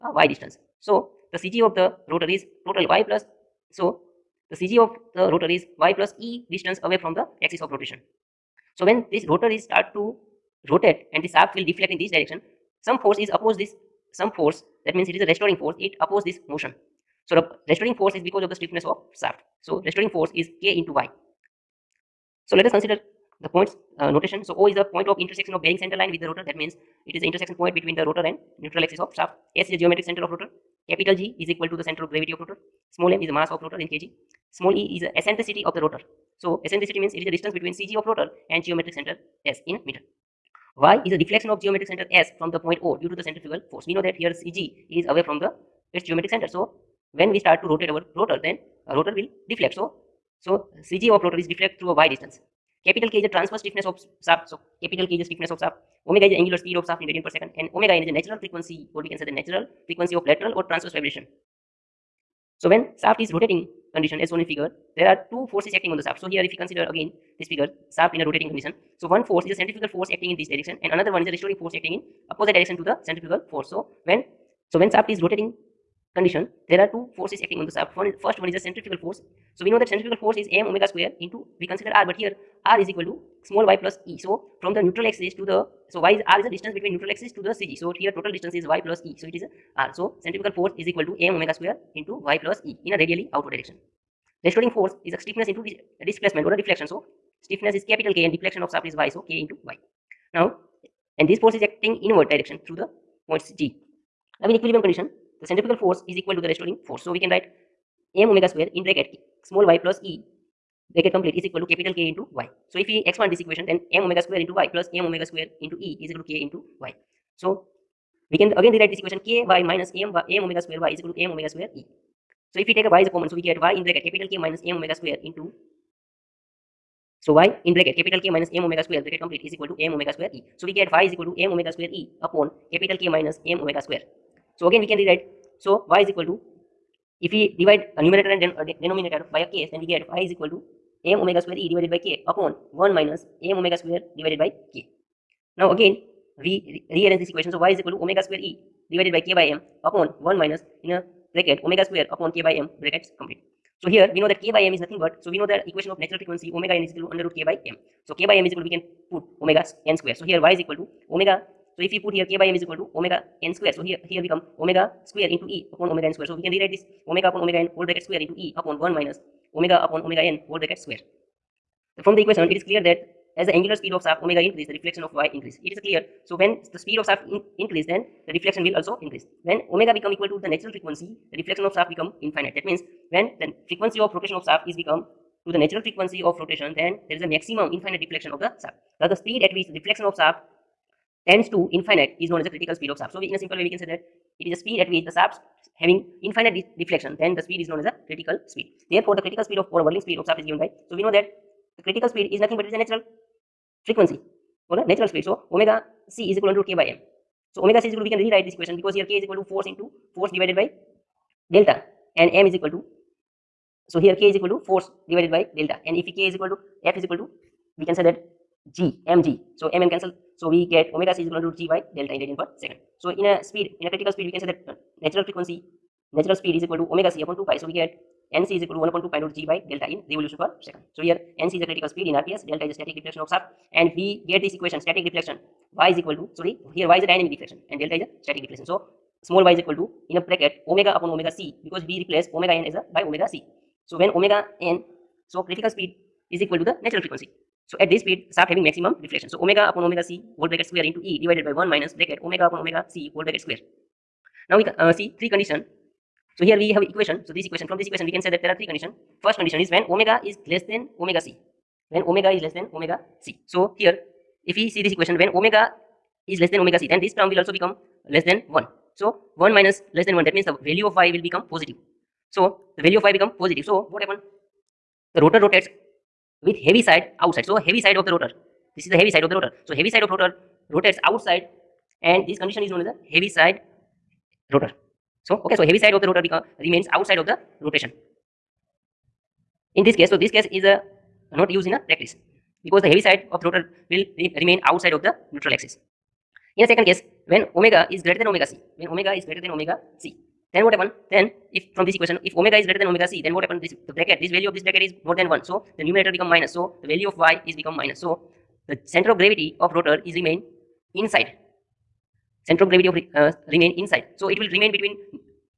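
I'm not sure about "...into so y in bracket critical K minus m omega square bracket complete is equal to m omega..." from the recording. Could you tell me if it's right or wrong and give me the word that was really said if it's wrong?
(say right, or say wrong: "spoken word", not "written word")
wrong: "capital", not "critical".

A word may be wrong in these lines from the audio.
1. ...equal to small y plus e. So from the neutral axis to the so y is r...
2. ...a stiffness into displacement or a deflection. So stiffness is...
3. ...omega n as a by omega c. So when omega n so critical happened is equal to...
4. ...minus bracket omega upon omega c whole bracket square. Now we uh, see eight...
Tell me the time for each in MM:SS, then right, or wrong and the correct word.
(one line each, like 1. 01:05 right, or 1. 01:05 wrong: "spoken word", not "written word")
1. 01:22 right
2. 01:35 right
3. 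04:02 wrong: "speed", not "happened"
4. 04:11 wrong: "three", not "eight".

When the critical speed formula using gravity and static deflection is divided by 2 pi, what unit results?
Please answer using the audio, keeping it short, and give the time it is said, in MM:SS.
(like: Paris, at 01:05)
Revolution per second, at 03:50.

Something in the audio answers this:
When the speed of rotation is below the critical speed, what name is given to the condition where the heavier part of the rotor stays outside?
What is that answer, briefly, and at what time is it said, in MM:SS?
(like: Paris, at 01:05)
Heavy side rotor, at 04:43.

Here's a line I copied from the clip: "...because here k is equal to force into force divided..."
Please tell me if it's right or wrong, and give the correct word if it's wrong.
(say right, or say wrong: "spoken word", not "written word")
right.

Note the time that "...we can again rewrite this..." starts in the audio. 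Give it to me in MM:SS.
01:58.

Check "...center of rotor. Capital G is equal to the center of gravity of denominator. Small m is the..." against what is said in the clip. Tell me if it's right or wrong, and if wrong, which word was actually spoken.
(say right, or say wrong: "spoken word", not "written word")
wrong: "rotor", not "denominator".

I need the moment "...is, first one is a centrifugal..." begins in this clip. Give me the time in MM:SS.
01:18.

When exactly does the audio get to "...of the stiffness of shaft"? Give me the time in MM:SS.
00:18.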